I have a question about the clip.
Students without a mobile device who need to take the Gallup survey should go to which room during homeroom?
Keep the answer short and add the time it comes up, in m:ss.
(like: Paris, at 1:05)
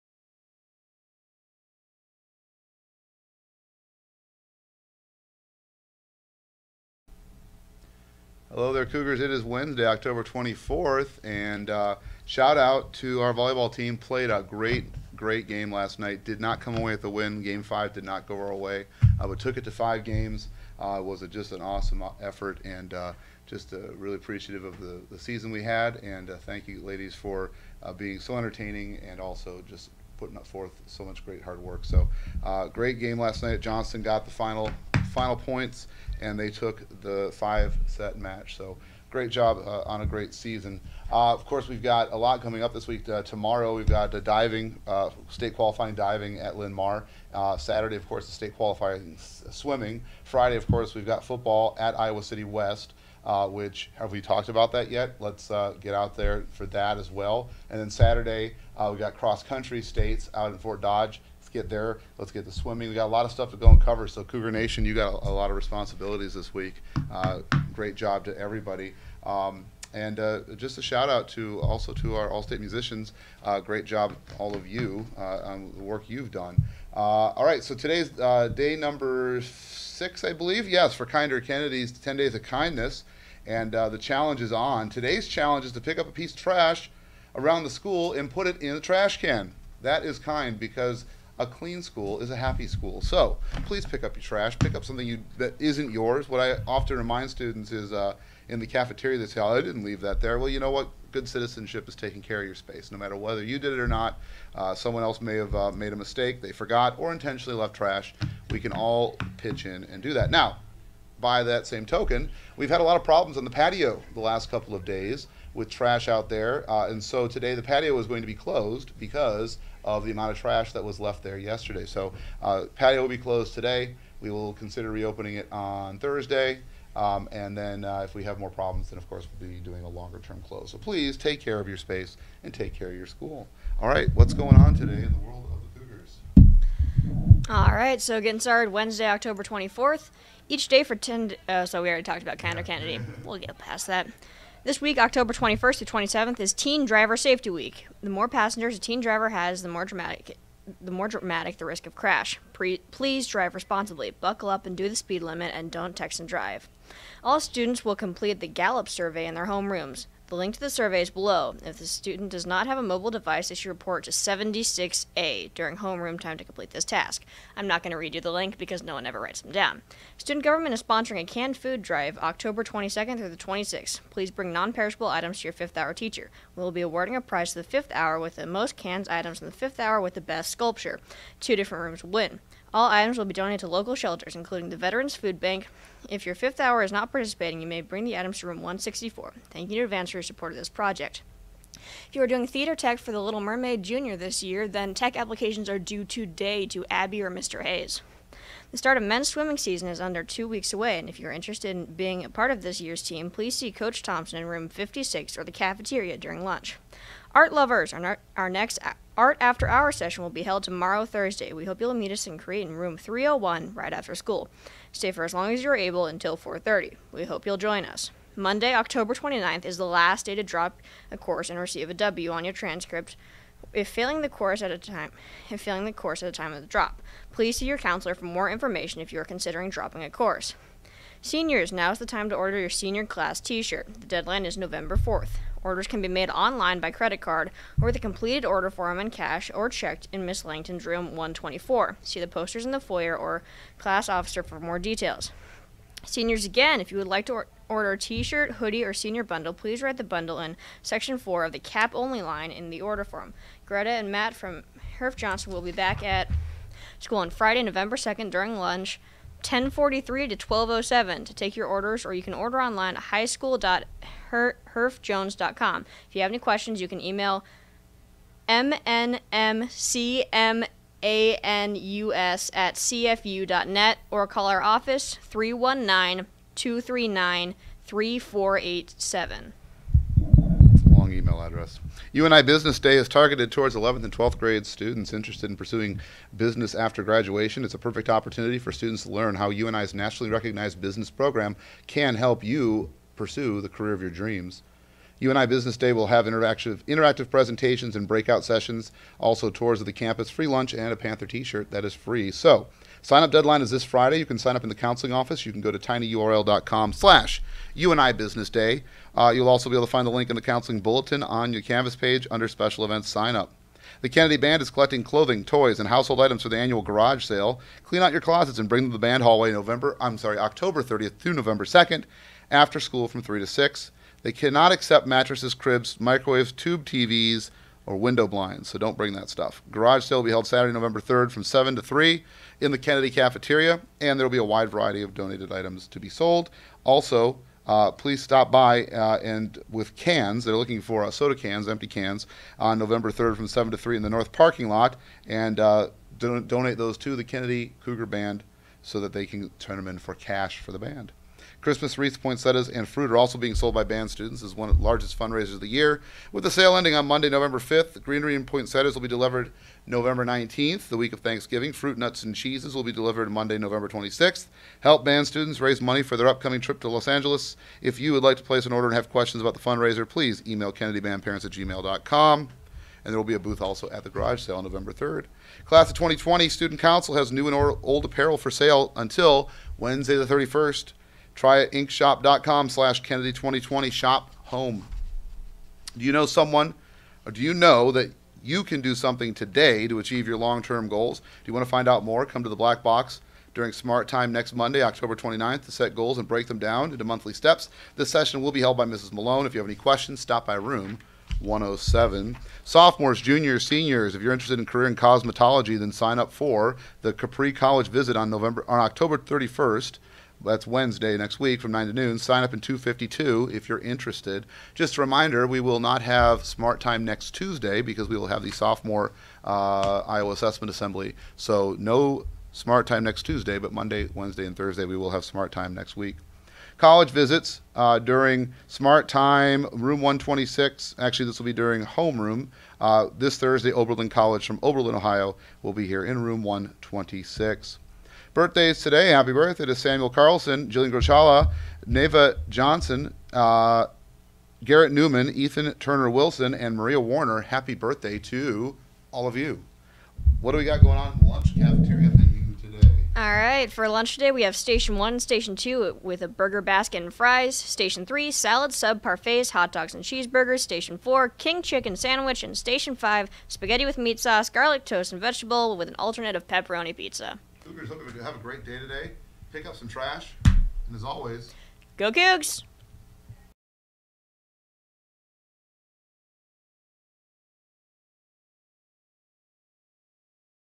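76A, at 2:44.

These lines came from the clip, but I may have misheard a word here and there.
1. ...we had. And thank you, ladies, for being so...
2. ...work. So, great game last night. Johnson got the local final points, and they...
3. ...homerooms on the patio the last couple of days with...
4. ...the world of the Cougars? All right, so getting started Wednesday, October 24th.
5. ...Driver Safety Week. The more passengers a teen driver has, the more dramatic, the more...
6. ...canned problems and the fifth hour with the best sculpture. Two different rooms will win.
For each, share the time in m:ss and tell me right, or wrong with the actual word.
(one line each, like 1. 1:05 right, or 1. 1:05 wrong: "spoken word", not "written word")
1. 0:25 right
2. 0:31 wrong: "final", not "local"
3. 1:53 wrong: "problems", not "homerooms"
4. 2:15 right
5. 2:26 right
6. 2:58 wrong: "items", not "problems".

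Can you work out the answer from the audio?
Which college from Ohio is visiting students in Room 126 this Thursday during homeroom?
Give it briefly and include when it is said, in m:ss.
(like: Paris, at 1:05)
Oberlin College, at 7:13.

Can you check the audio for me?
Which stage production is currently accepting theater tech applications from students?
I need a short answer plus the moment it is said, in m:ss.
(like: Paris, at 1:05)
The Little Mermaid Jr., at 3:13.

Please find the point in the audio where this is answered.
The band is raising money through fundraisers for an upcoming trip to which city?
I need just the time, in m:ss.
6:06.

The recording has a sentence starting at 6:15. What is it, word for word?
Class of 2020 Student Council has new and old apparel for sale until Wednesday the 31st.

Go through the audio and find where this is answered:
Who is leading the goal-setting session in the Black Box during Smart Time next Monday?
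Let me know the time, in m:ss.
6:38.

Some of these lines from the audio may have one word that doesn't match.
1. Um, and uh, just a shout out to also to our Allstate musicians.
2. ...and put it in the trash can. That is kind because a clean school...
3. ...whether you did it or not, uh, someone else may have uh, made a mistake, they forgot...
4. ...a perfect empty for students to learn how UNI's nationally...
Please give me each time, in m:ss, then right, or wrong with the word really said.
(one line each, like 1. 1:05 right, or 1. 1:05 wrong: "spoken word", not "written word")
1. 1:09 right
2. 1:28 right
3. 1:43 right
4. 4:47 wrong: "opportunity", not "empty".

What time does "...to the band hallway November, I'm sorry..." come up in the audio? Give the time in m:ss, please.
5:18.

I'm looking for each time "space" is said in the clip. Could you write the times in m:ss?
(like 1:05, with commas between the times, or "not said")
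1:42, 2:11.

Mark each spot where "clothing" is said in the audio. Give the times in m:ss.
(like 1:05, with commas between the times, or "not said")
5:15.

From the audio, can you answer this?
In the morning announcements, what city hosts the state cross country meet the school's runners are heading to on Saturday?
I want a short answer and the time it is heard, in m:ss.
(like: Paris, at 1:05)
Fort Dodge, at 1:00.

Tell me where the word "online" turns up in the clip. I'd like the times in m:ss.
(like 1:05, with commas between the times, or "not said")
3:56, 4:22.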